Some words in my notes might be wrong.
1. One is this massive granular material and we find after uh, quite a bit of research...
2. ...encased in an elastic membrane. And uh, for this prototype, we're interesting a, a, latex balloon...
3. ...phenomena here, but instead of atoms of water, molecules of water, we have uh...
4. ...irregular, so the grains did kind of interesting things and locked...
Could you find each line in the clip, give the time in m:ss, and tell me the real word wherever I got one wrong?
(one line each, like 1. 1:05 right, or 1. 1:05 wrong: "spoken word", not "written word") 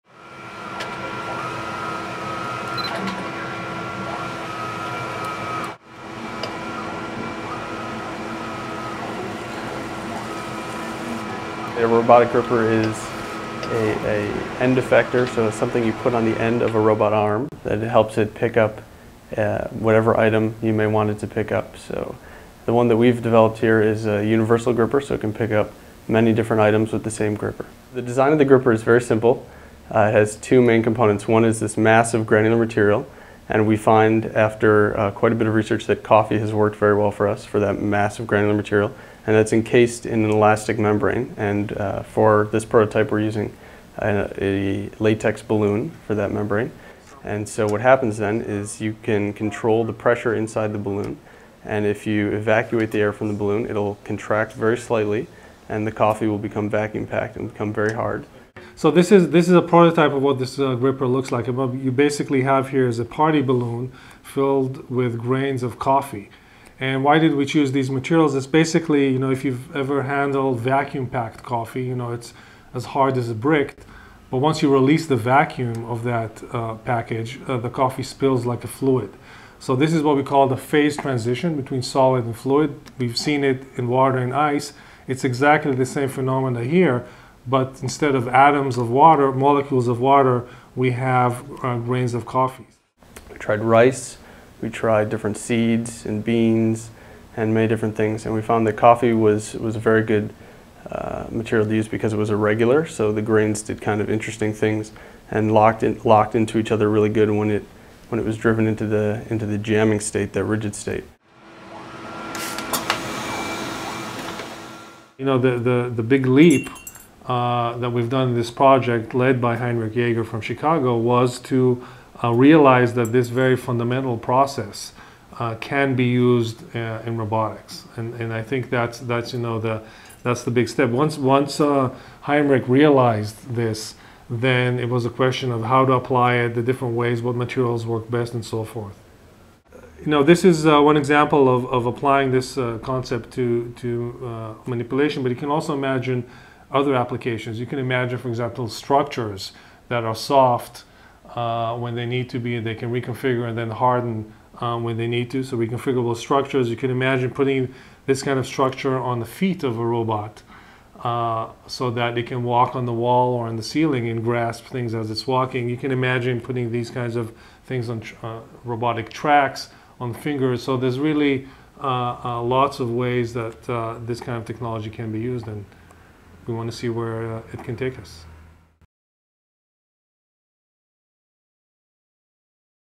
1. 0:31 right
2. 0:39 wrong: "using", not "interesting"
3. 1:26 right
4. 1:42 right.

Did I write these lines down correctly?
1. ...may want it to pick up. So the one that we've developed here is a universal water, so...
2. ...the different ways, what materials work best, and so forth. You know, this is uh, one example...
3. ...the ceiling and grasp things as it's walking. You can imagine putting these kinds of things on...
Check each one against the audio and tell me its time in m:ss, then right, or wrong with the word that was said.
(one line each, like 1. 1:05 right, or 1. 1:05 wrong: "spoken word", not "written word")
1. 0:20 wrong: "gripper", not "water"
2. 2:16 right
3. 2:43 right.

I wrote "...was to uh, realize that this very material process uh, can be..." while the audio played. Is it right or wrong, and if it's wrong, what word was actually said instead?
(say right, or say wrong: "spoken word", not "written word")
wrong: "fundamental", not "material".